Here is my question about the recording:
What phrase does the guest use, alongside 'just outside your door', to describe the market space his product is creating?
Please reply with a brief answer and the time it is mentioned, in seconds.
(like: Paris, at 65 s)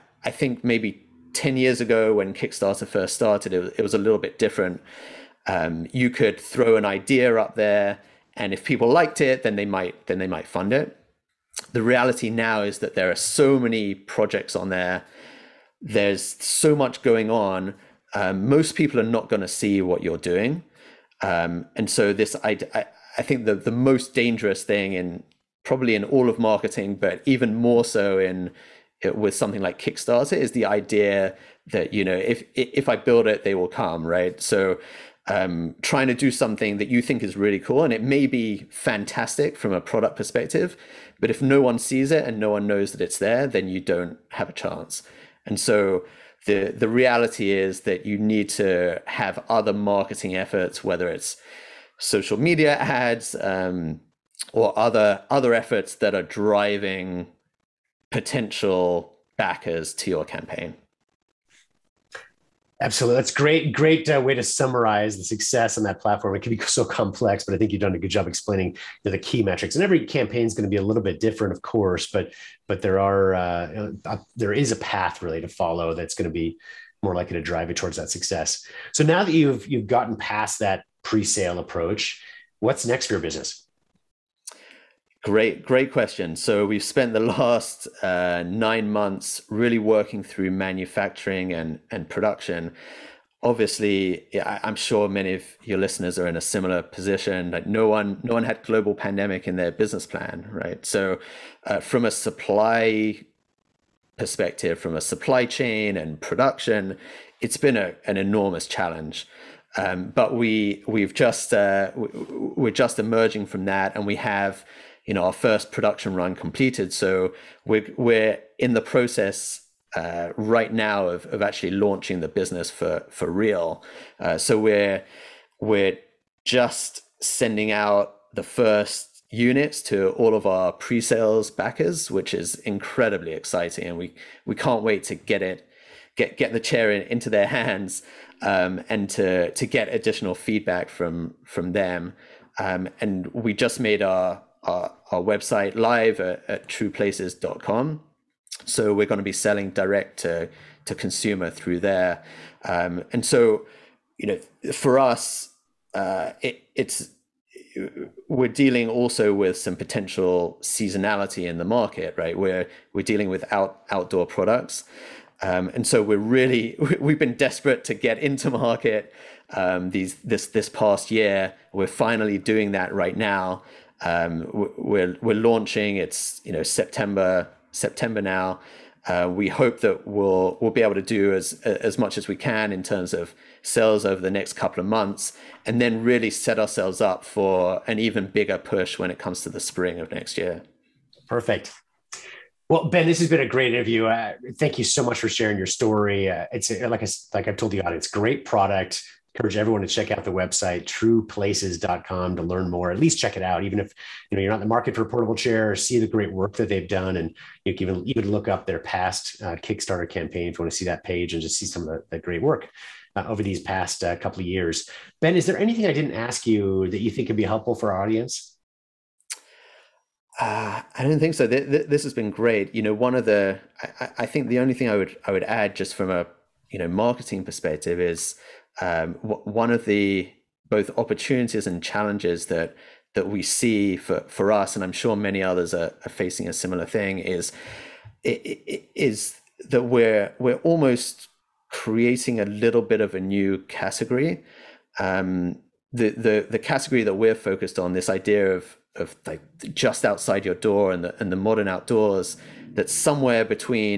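The modern outdoors, at 251 s.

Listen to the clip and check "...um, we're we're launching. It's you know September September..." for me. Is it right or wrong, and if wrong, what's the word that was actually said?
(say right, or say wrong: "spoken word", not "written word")
right.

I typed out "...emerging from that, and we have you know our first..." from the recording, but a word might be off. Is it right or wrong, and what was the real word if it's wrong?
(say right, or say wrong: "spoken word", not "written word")
right.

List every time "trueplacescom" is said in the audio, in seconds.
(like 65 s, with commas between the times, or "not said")
146 s, 200 s.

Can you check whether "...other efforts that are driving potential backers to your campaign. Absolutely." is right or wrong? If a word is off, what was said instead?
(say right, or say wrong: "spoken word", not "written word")
right.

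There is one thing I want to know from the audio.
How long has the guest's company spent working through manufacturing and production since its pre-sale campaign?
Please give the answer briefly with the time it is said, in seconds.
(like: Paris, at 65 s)
9 months, at 88 s.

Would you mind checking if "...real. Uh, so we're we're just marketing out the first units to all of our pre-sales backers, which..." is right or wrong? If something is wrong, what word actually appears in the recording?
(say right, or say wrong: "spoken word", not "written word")
wrong: "sending", not "marketing".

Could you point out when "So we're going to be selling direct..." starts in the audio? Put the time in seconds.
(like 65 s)
148 s.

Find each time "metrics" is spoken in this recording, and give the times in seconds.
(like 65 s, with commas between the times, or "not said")
69 s.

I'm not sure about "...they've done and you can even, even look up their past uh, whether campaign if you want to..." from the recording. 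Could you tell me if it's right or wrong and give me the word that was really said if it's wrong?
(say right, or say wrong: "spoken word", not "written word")
wrong: "kickstarter", not "whether".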